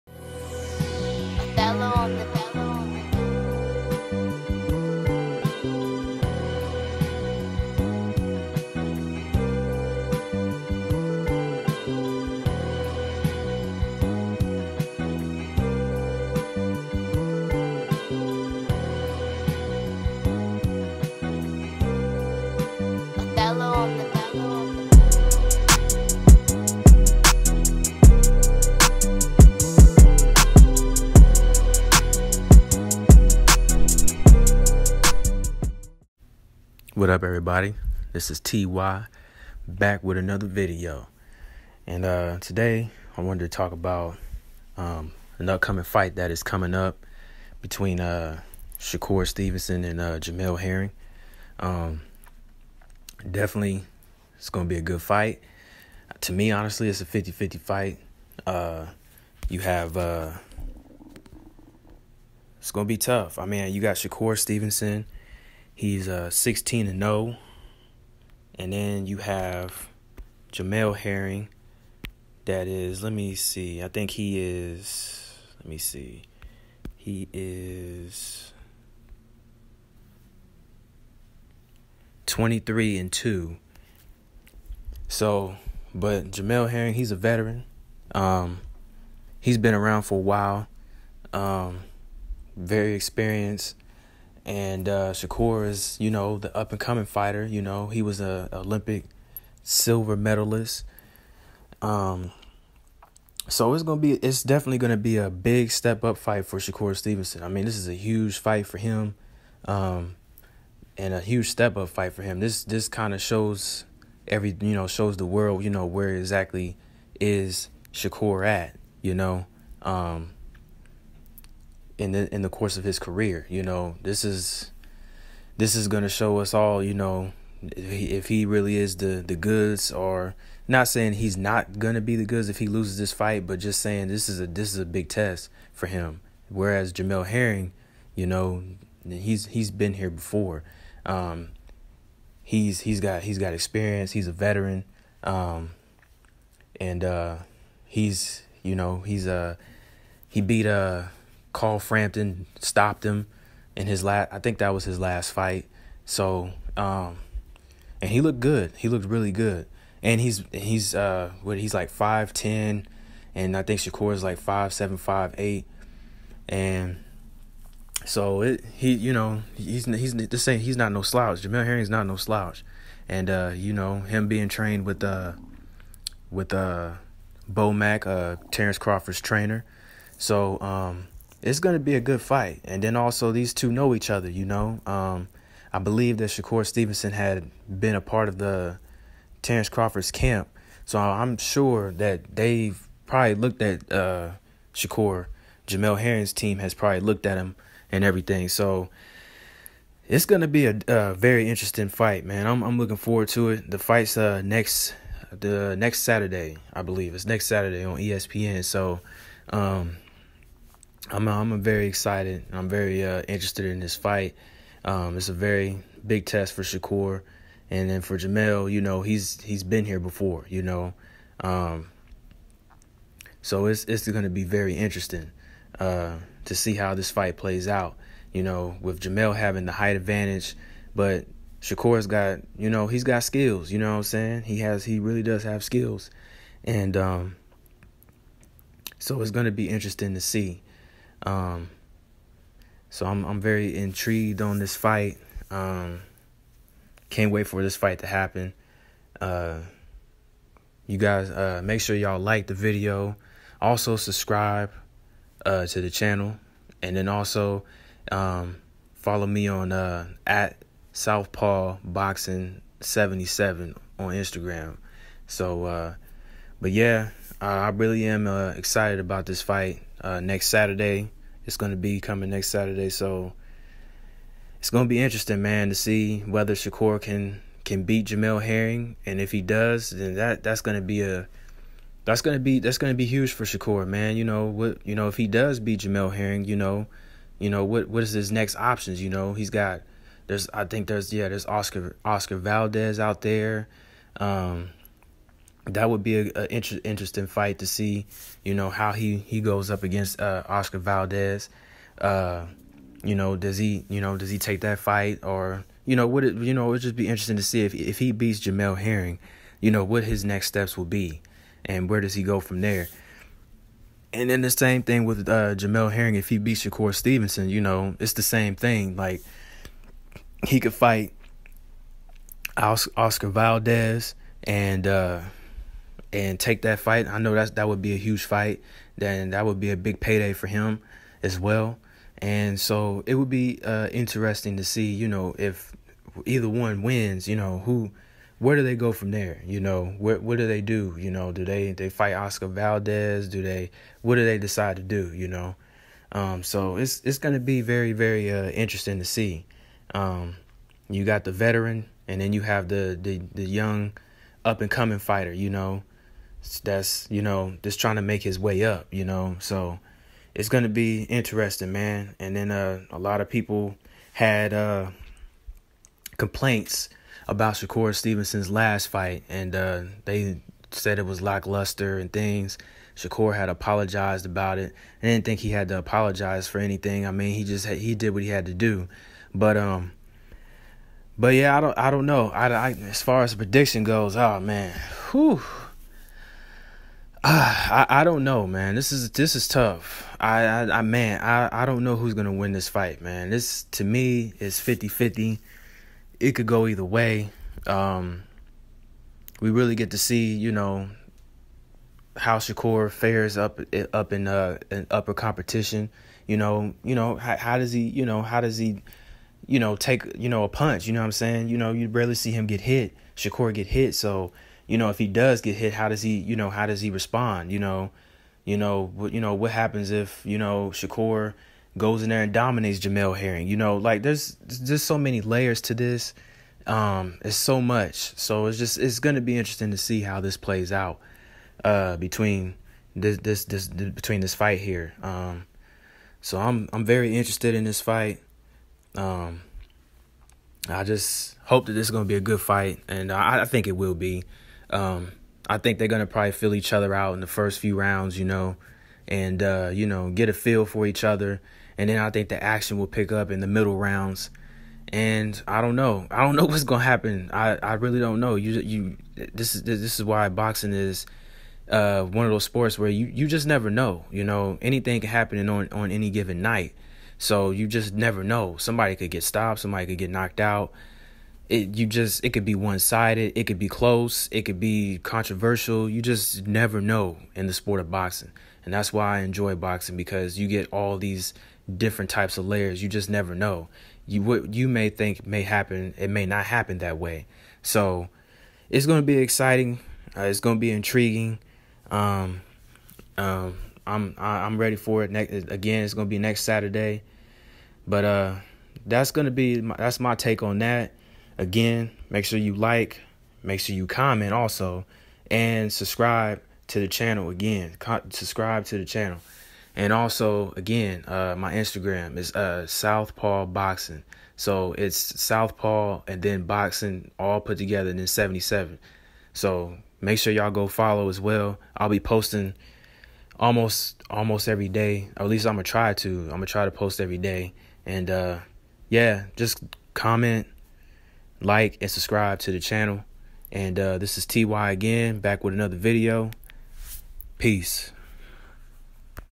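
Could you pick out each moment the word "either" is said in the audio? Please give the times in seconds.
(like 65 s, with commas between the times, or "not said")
336 s, 396 s.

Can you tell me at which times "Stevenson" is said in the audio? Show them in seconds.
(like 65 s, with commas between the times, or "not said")
49 s, 64 s, 106 s, 186 s, 316 s, 367 s.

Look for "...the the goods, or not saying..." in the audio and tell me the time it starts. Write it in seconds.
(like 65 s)
128 s.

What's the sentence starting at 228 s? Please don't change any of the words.
You know, with Jamel having the height advantage, but Shakur's got you know he's got skills.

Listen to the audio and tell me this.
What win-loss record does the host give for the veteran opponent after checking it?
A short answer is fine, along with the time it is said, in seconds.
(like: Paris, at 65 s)
23-2, at 82 s.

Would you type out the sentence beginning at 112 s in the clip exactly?
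This this kind of shows every, you know, shows the world, you know, where exactly is Shakur at, you know.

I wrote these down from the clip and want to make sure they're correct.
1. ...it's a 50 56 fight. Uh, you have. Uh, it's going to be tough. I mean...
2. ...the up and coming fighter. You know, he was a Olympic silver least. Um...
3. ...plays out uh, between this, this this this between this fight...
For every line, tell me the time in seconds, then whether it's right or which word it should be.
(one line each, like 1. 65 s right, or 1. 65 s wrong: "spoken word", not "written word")
1. 56 s wrong: "50", not "56"
2. 96 s wrong: "medalist", not "least"
3. 430 s right.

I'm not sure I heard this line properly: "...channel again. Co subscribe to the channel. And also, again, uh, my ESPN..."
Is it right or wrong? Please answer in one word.
wrong.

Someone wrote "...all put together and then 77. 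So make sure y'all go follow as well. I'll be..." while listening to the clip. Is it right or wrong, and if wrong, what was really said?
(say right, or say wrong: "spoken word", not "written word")
right.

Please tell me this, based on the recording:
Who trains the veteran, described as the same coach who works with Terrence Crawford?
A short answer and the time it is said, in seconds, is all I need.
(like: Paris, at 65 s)
Bo Mack, at 177 s.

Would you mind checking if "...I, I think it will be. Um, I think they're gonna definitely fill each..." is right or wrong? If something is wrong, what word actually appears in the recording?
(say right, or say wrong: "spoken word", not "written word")
wrong: "probably", not "definitely".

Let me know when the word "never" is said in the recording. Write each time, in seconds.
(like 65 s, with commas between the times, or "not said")
463 s, 467 s, 476 s, 483 s.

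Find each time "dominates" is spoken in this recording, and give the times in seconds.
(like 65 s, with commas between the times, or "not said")
422 s.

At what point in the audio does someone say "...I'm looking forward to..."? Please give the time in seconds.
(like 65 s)
202 s.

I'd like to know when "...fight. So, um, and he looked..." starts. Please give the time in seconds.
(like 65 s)
155 s.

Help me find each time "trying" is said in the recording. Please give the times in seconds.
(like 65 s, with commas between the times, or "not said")
357 s.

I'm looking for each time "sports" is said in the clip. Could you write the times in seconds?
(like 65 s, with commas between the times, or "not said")
462 s, 477 s.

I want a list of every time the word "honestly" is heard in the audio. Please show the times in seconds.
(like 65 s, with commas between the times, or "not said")
56 s.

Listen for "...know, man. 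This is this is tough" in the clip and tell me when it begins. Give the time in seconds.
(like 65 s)
388 s.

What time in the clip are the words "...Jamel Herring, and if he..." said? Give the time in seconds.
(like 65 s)
278 s.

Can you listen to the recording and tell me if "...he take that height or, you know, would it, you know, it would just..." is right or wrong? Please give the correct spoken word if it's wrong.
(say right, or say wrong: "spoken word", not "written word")
wrong: "fight", not "height".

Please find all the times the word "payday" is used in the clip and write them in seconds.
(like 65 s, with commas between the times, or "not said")
329 s.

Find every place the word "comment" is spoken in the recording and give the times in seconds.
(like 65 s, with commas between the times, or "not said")
503 s, 529 s.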